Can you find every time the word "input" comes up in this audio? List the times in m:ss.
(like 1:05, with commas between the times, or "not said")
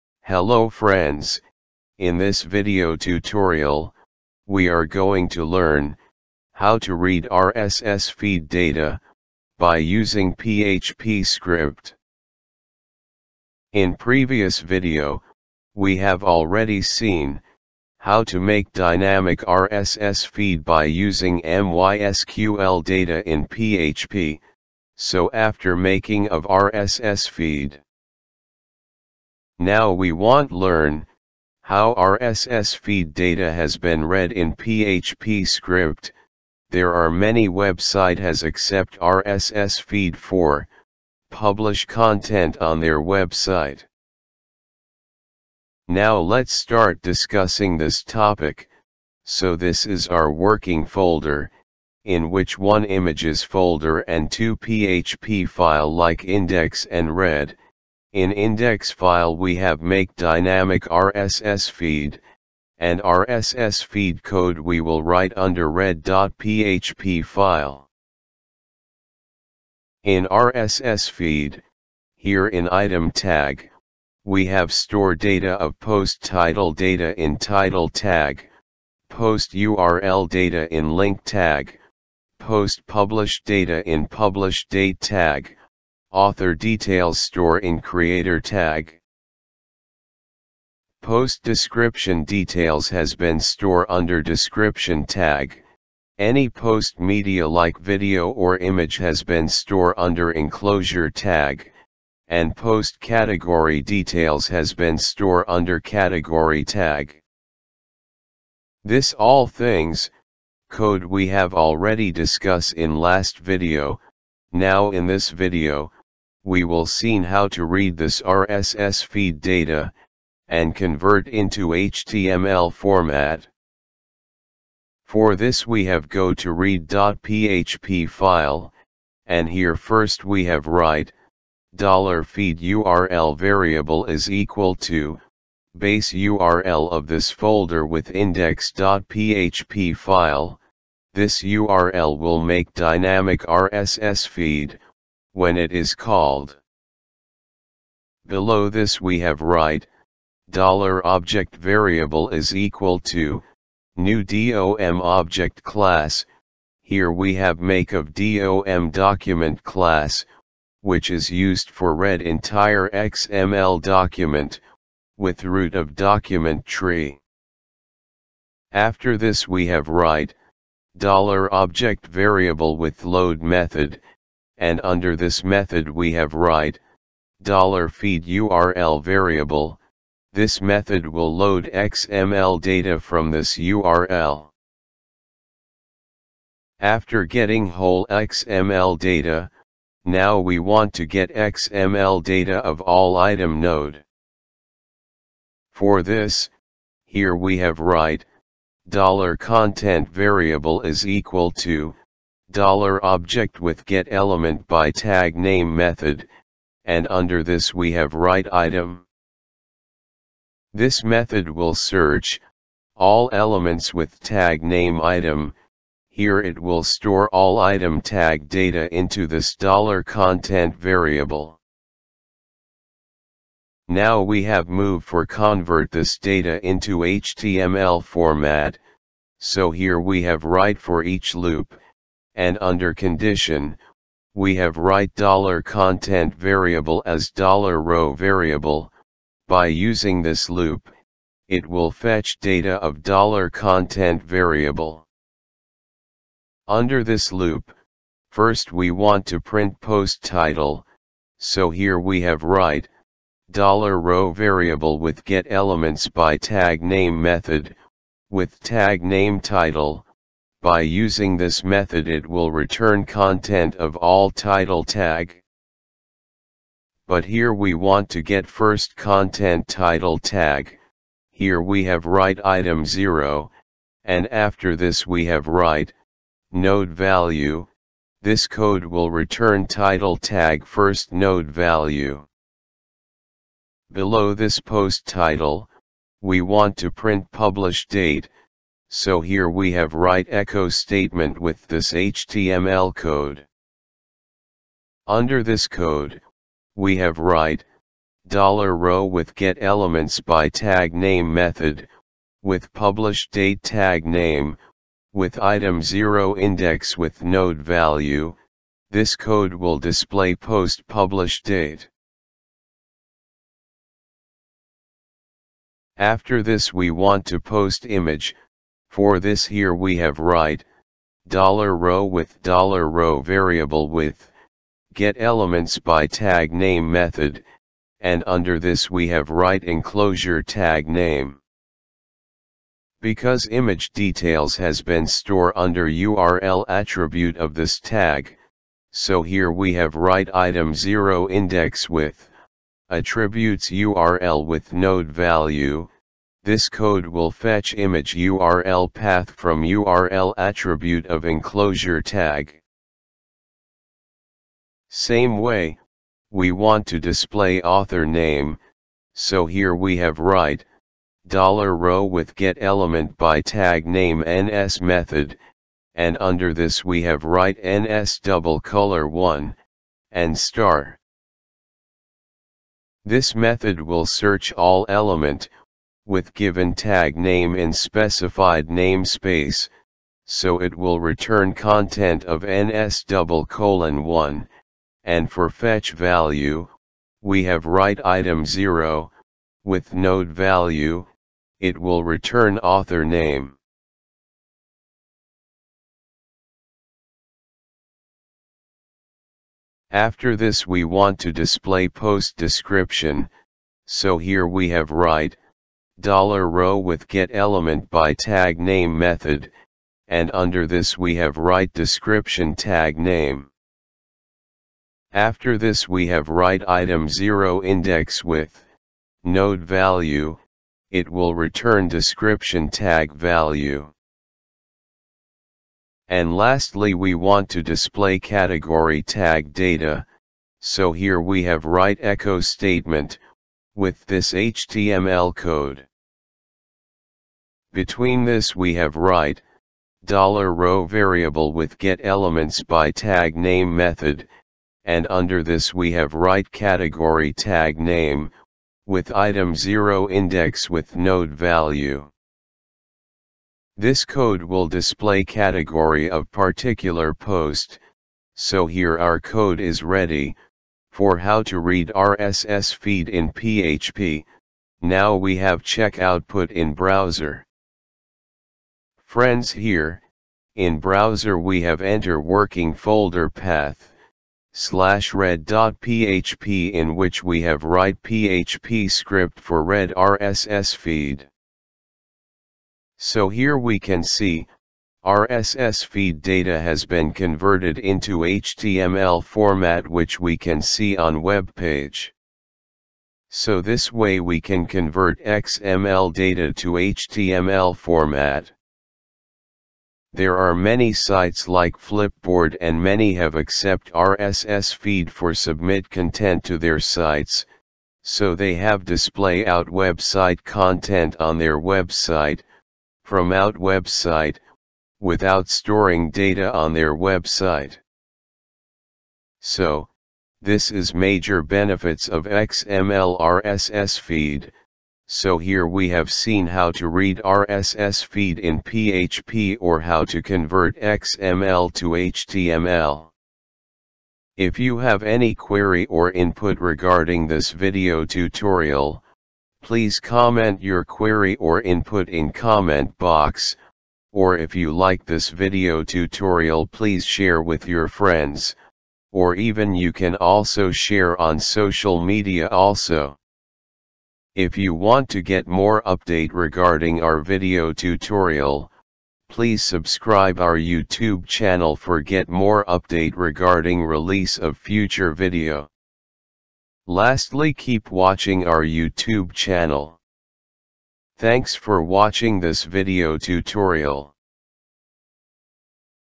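8:56, 9:01.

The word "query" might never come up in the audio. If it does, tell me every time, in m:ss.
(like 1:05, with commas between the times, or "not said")
8:55, 9:00.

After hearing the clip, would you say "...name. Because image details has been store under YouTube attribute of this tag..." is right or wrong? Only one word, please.
wrong.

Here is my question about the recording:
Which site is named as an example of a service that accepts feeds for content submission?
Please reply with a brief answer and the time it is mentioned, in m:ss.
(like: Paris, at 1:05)
Flipboard, at 8:21.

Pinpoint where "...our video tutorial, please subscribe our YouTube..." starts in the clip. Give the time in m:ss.
9:17.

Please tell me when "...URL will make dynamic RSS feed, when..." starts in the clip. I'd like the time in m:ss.
2:21.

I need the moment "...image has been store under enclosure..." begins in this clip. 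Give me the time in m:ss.
1:38.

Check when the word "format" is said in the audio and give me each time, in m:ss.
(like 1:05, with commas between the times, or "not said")
2:02, 3:48, 8:09, 8:17.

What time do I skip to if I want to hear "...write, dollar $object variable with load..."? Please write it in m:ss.
2:49.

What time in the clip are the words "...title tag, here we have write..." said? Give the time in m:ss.
4:29.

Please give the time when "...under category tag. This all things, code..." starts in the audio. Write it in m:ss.
1:45.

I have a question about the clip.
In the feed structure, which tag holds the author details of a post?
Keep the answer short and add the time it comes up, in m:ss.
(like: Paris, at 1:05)
creator, at 1:27.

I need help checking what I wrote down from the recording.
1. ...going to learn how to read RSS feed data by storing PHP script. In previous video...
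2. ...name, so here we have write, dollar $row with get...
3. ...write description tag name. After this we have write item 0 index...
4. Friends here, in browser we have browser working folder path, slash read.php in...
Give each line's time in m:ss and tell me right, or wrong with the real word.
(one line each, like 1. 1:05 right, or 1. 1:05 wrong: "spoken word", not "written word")
1. 0:04 wrong: "using", not "storing"
2. 5:58 right
3. 6:51 right
4. 7:49 wrong: "enter", not "browser".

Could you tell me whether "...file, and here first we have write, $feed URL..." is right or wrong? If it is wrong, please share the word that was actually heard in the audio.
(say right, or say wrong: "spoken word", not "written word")
right.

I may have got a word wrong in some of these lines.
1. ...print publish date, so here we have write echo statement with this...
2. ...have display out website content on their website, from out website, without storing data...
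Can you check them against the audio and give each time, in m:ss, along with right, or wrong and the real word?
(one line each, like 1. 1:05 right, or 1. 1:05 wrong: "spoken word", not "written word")
1. 4:46 right
2. 8:28 right.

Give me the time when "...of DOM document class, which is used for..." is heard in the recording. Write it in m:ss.
2:37.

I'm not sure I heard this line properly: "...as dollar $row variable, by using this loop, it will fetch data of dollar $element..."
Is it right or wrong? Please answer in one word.
wrong.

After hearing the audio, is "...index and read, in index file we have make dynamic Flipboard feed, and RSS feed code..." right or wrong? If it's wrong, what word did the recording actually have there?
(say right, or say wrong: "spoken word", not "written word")
wrong: "RSS", not "Flipboard".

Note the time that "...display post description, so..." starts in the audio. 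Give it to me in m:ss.
6:41.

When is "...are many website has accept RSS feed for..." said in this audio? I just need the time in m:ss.
0:36.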